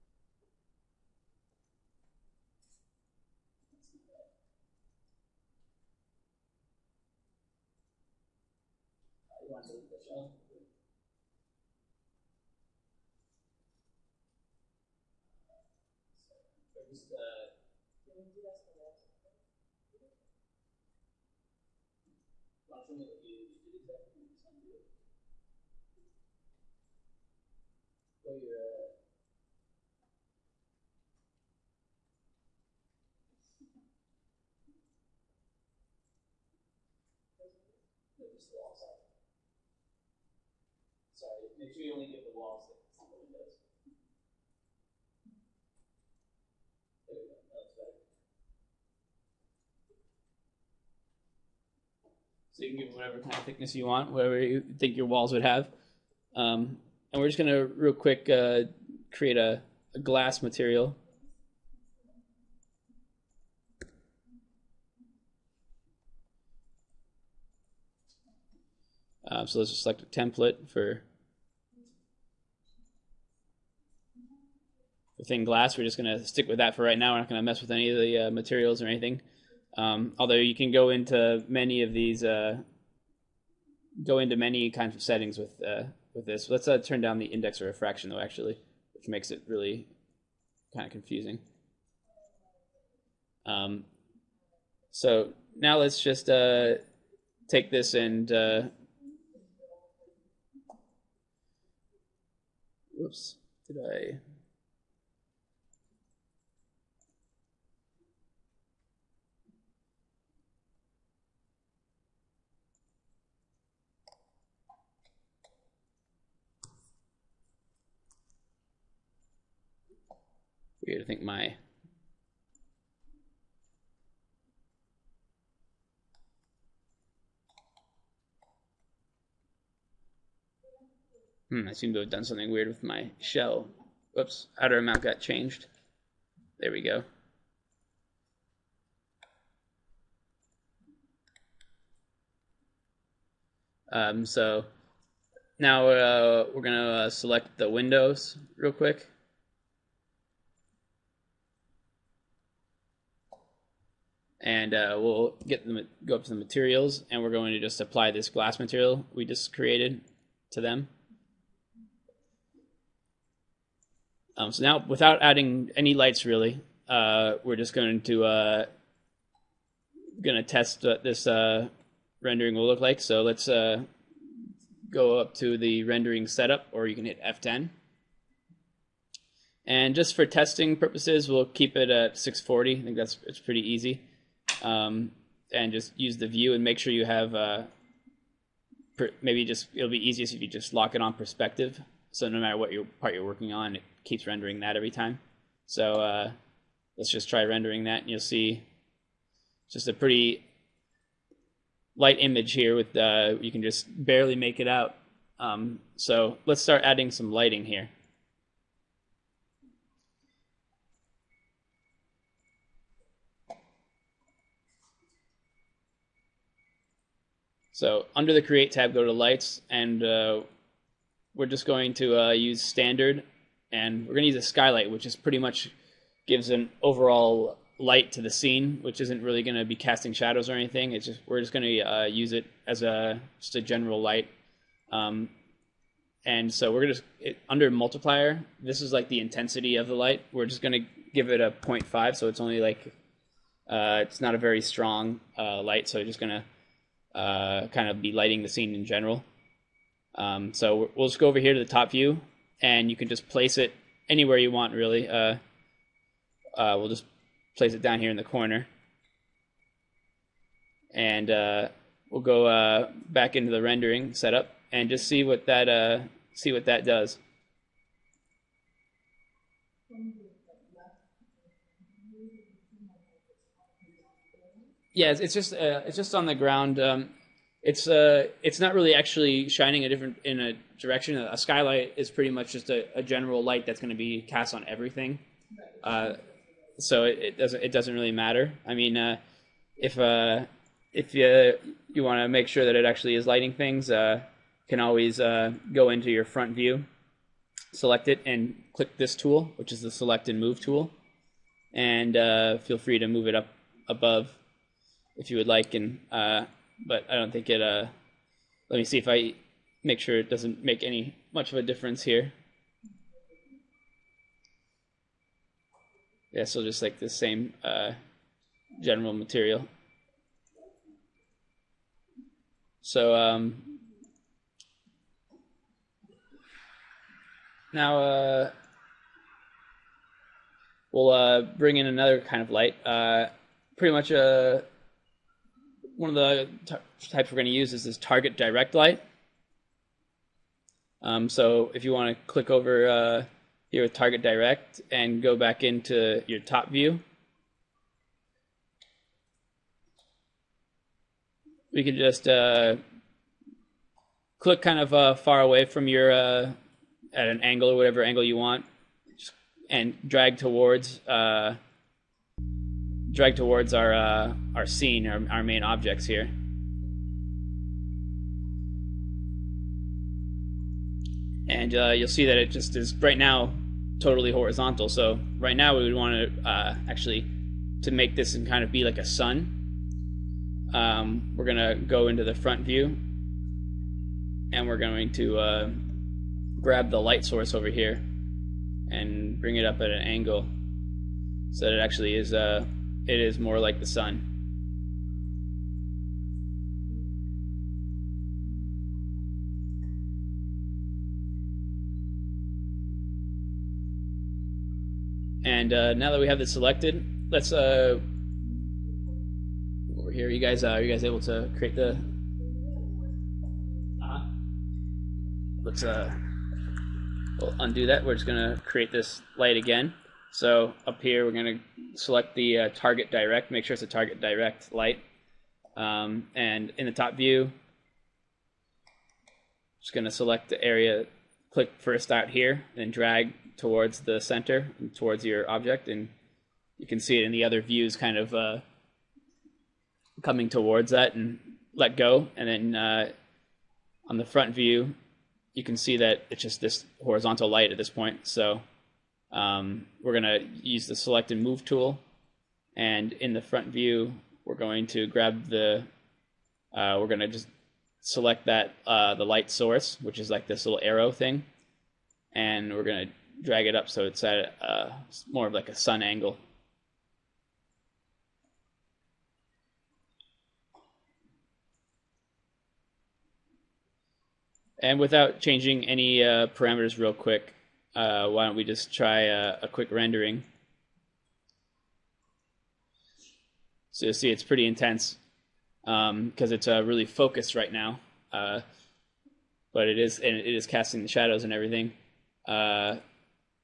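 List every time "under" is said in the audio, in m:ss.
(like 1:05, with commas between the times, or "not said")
3:38, 3:57.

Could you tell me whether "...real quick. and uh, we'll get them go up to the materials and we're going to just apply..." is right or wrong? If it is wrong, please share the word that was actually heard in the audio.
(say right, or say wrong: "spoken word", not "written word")
right.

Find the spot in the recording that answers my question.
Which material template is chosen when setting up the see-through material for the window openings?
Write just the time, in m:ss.
1:15.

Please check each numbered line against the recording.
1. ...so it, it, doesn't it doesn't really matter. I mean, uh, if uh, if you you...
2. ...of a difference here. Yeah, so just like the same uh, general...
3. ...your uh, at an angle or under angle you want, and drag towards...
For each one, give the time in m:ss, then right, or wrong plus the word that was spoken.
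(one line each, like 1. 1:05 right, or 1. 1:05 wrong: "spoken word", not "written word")
1. 4:46 right
2. 5:11 right
3. 5:55 wrong: "whatever", not "under".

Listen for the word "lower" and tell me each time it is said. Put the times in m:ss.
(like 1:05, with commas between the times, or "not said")
not said.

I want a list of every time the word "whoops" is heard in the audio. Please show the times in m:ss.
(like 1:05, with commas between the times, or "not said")
1:42, 2:14.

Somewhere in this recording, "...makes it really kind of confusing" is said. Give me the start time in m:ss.
1:29.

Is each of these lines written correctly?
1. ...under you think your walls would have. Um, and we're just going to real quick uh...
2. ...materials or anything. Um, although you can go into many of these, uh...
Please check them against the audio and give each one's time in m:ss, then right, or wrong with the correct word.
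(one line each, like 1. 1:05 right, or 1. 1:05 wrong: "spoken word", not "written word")
1. 0:54 wrong: "whatever", not "under"
2. 1:18 right.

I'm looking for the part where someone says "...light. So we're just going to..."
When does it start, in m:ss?
4:05.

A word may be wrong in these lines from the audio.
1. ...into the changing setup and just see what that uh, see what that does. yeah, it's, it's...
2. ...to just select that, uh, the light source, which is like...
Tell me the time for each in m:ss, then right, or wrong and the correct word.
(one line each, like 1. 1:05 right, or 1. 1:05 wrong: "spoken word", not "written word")
1. 4:23 wrong: "rendering", not "changing"
2. 7:37 right.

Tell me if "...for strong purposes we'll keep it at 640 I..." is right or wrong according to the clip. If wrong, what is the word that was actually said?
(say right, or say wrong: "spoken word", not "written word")
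wrong: "testing", not "strong".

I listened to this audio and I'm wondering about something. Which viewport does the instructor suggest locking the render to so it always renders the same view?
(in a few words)
Perspective.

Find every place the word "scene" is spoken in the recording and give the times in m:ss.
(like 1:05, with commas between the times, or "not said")
3:48, 4:08, 6:04.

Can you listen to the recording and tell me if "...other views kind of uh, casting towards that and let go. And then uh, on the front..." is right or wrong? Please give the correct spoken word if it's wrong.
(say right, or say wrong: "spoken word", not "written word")
wrong: "coming", not "casting".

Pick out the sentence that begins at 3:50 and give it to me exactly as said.
It's just we're just going to uh, use it as a just a general light.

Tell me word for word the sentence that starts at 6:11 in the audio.
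And uh, you'll see that it just is right now totally horizontal.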